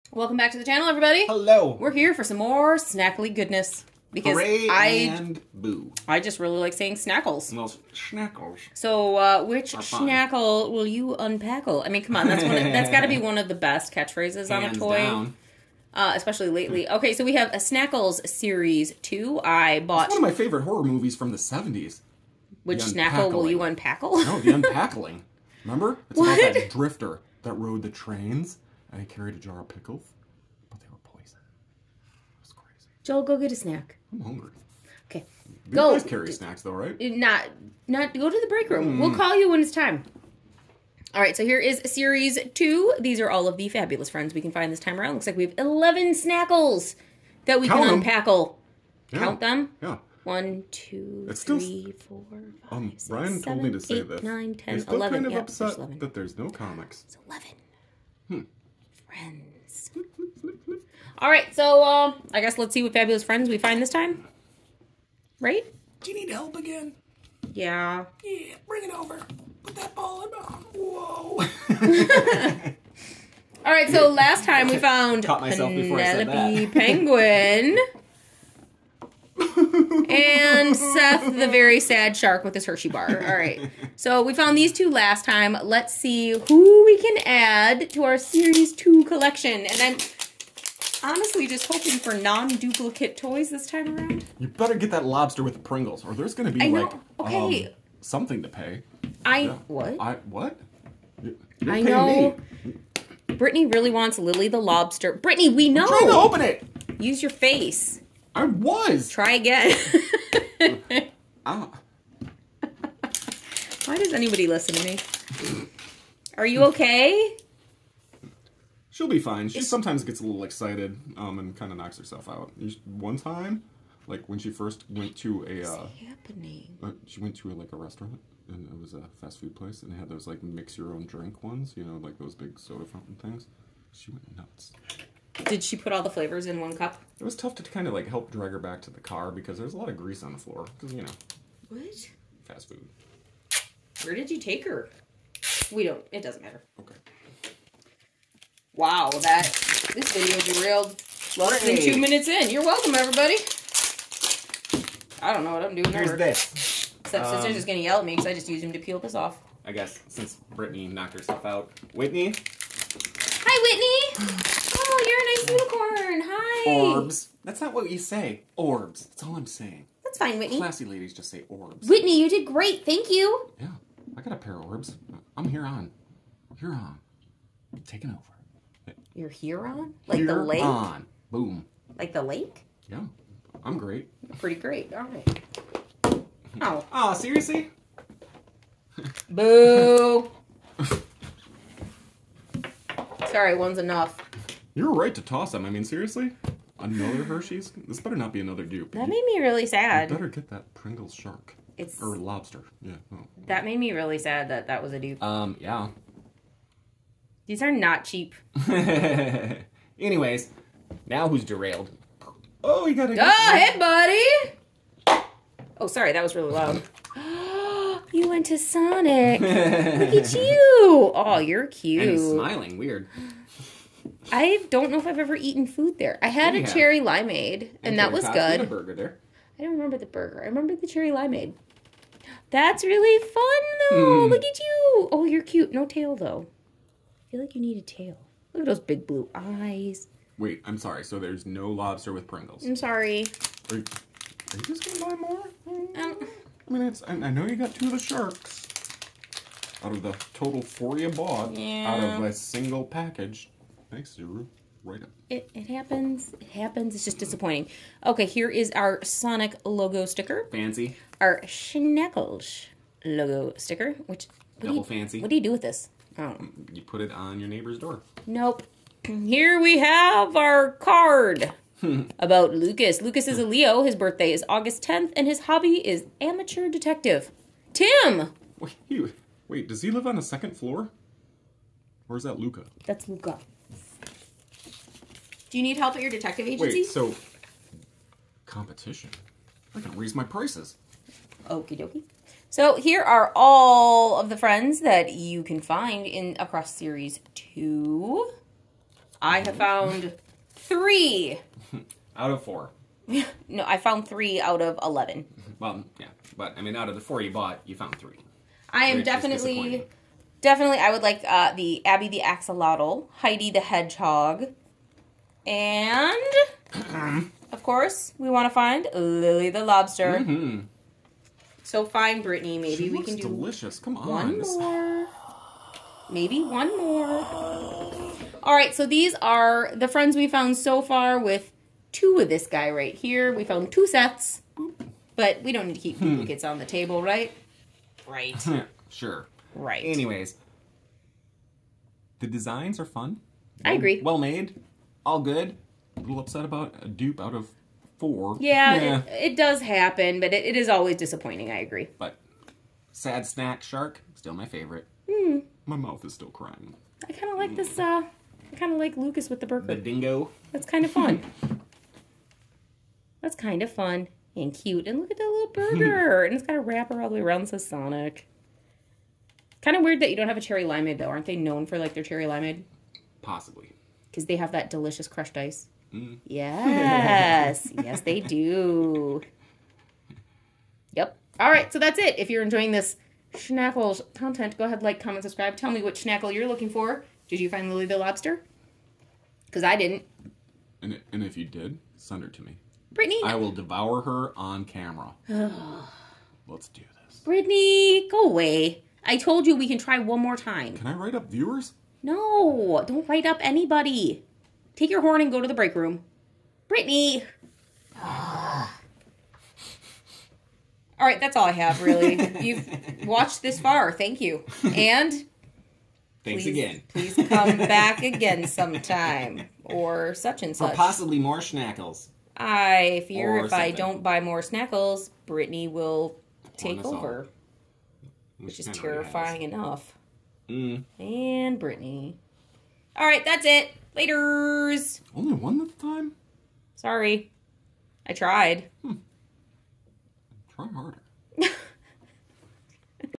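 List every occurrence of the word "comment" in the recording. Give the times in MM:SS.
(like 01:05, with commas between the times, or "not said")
06:24.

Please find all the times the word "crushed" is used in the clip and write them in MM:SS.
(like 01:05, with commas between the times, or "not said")
06:15.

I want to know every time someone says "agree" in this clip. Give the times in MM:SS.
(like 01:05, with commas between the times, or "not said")
05:43, 05:51.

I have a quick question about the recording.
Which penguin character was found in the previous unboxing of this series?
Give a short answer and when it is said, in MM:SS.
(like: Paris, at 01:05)
Penelope, at 01:15.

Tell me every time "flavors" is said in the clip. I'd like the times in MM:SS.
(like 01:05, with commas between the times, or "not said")
02:16.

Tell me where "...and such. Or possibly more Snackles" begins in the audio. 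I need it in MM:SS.
07:00.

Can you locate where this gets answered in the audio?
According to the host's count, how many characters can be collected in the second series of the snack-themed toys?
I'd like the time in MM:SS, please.
00:45.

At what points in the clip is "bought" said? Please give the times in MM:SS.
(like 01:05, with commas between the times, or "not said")
00:19, 04:11, 05:07.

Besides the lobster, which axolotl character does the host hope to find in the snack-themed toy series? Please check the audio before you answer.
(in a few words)
Abby.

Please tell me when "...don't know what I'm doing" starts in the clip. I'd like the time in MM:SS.
02:35.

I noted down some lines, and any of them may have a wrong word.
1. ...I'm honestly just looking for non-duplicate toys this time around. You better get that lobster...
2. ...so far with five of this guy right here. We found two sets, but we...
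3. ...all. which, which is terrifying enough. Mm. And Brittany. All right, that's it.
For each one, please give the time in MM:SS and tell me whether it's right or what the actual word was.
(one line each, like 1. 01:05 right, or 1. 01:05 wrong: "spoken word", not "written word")
1. 01:29 wrong: "hoping", not "looking"
2. 05:30 wrong: "two", not "five"
3. 07:07 right.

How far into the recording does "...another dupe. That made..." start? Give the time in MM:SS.
03:18.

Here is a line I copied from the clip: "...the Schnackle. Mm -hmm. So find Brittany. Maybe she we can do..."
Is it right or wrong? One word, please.
wrong.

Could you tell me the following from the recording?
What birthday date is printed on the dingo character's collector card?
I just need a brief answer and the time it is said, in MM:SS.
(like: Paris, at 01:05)
August 10th, at 04:34.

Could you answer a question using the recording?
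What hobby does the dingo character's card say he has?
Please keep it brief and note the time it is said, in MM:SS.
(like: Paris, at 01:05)
amateur detective, at 04:36.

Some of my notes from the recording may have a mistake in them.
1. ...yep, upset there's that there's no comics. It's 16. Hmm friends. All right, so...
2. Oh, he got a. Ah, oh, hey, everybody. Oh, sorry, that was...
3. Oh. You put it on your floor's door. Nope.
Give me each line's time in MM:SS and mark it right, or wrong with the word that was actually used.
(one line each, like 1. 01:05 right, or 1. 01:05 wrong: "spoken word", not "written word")
1. 00:55 wrong: "11", not "16"
2. 03:32 wrong: "buddy", not "everybody"
3. 04:26 wrong: "neighbor", not "floor".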